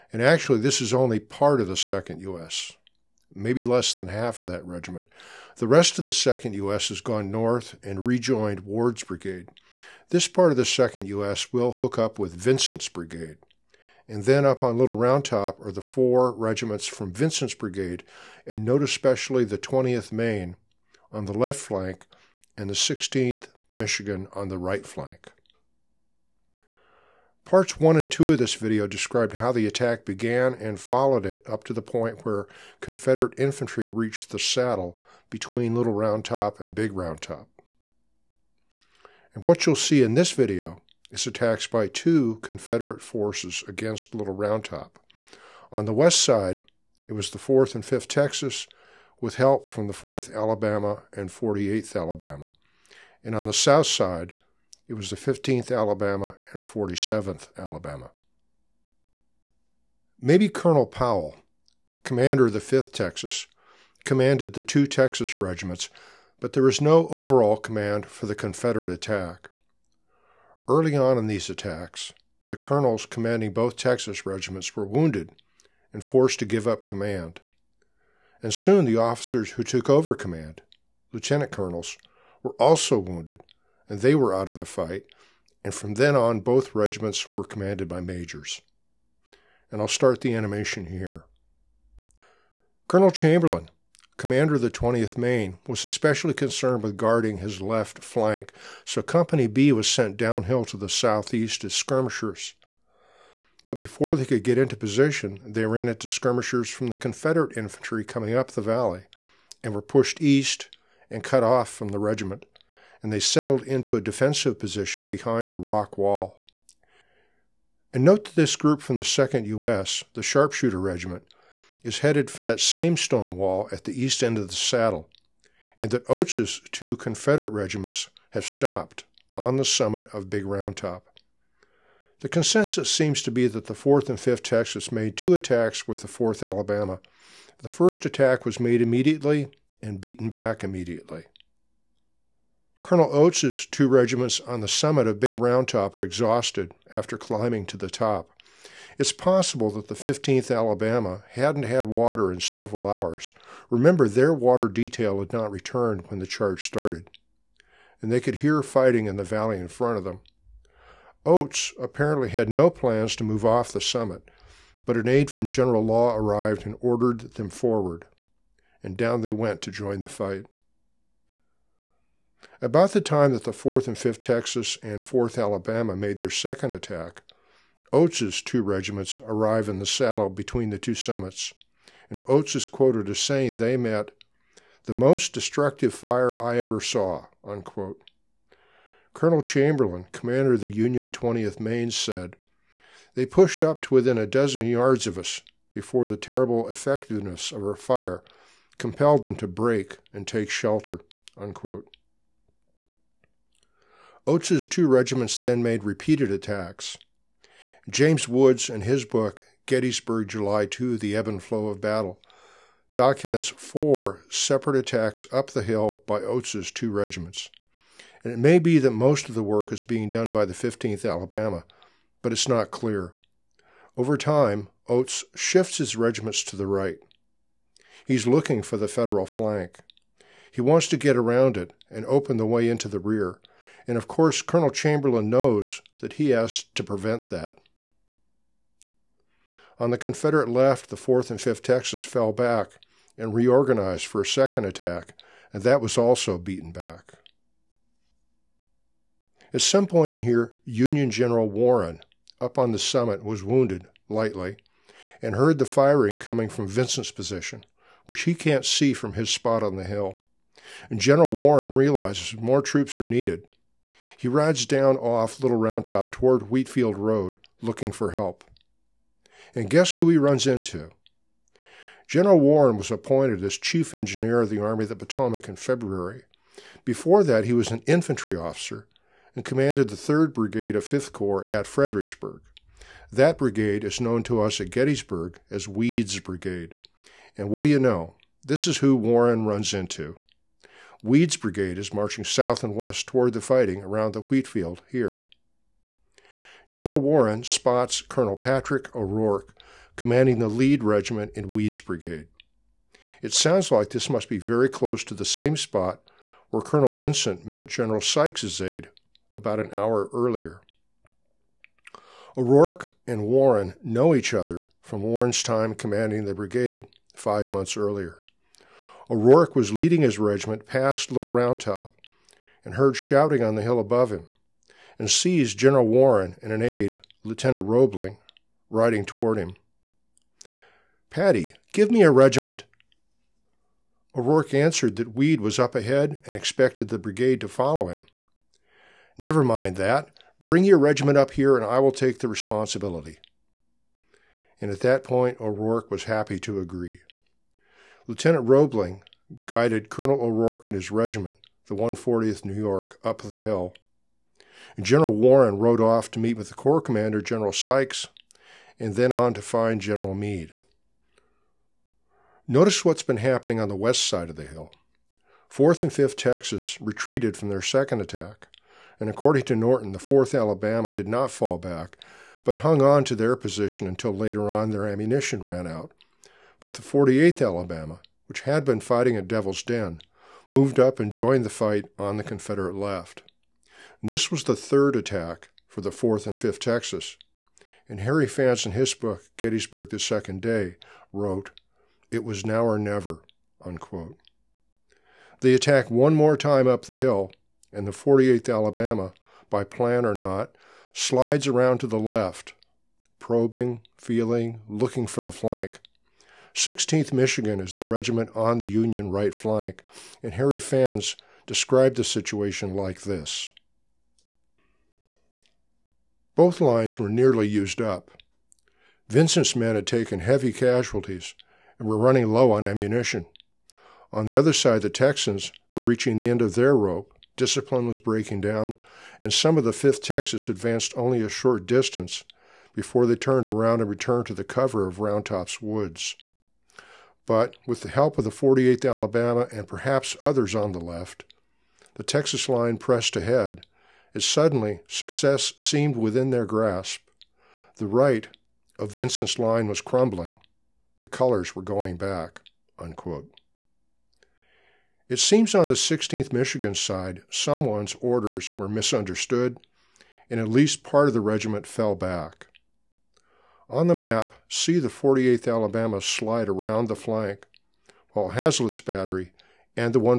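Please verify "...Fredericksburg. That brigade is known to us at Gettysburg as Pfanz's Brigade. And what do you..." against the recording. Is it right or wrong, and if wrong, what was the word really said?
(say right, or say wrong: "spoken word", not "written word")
wrong: "Weed", not "Pfanz".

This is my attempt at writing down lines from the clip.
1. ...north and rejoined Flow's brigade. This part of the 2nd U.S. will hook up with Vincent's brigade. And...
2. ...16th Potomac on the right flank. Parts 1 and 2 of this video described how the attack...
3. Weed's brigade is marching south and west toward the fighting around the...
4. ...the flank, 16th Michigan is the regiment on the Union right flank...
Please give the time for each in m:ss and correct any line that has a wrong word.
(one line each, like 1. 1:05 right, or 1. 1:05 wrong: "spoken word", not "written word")
1. 0:07 wrong: "Ward", not "Flow"
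2. 0:22 wrong: "Michigan", not "Potomac"
3. 4:51 right
4. 6:45 right.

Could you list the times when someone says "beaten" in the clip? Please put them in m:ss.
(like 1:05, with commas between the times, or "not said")
2:19, 4:06.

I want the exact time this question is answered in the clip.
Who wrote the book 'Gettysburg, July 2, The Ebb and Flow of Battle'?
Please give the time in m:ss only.
3:27.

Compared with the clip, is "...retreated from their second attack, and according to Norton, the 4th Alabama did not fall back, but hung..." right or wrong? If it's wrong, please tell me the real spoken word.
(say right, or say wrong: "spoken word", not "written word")
right.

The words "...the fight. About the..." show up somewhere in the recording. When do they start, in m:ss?
2:50.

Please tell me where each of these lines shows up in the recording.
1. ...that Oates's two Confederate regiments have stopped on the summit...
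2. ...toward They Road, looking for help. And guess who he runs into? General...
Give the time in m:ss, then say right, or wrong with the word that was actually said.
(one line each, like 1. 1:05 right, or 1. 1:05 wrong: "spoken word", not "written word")
1. 2:05 right
2. 4:26 wrong: "Wheatfield", not "They".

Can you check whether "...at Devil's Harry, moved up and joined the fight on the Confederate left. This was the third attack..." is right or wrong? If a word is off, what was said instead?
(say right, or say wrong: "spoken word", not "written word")
wrong: "Den", not "Harry".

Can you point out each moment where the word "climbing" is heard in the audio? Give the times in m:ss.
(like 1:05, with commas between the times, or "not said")
2:27.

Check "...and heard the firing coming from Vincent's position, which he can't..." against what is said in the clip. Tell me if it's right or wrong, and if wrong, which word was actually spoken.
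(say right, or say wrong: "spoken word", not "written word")
right.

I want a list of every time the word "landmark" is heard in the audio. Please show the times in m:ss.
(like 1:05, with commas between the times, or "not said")
not said.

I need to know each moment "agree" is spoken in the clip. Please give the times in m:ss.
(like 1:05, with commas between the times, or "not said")
5:46.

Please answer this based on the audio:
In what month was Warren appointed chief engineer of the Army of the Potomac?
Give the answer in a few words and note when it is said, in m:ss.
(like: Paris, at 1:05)
February, at 4:35.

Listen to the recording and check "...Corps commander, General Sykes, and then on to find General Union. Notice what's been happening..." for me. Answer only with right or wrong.
wrong.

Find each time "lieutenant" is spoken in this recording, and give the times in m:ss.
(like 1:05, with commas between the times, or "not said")
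1:21, 5:27, 5:48.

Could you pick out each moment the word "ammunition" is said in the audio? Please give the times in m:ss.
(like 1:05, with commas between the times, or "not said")
6:14, 7:02.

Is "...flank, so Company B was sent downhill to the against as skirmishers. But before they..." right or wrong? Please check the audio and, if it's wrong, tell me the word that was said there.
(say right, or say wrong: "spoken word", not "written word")
wrong: "southeast", not "against".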